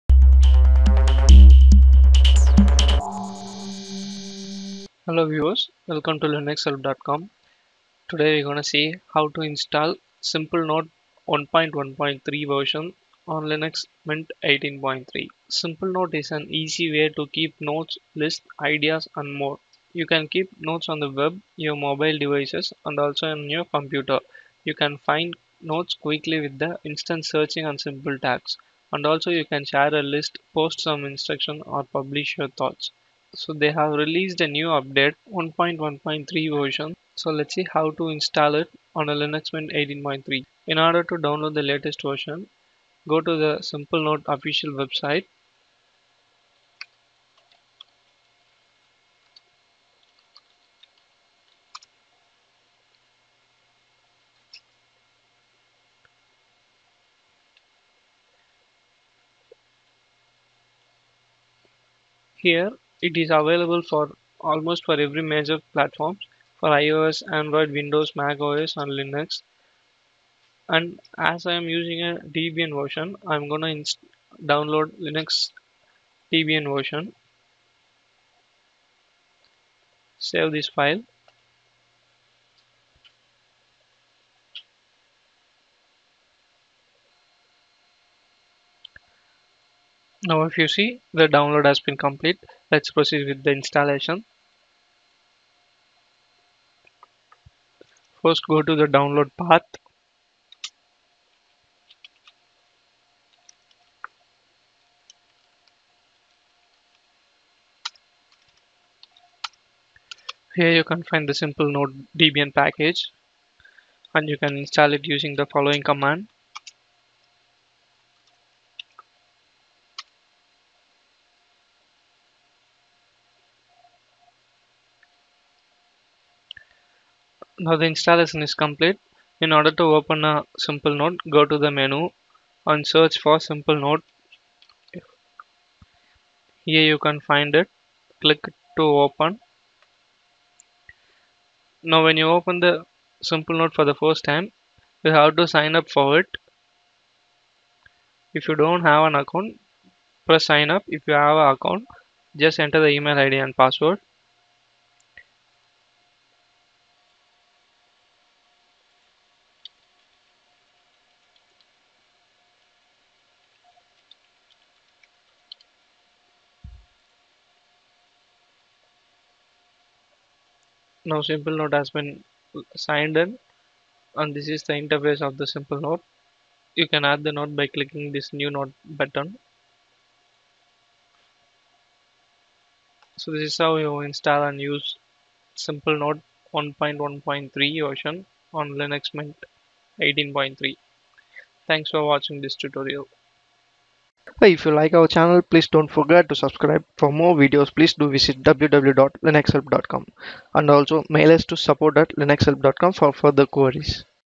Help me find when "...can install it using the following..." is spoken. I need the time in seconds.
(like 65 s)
114 s.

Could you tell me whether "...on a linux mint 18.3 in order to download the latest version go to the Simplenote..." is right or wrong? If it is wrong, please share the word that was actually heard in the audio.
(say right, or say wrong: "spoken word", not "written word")
right.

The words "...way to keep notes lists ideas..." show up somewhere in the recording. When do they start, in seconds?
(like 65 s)
16 s.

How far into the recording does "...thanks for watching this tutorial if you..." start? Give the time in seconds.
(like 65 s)
191 s.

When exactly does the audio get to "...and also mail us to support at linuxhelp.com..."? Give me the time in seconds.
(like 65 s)
200 s.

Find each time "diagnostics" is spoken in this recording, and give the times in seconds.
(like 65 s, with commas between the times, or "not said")
not said.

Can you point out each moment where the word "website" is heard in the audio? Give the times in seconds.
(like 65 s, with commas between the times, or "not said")
44 s.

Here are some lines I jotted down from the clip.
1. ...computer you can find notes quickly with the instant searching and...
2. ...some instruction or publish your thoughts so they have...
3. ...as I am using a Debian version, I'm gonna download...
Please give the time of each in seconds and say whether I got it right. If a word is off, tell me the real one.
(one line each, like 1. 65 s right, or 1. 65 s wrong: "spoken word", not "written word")
1. 23 s right
2. 30 s right
3. 71 s right.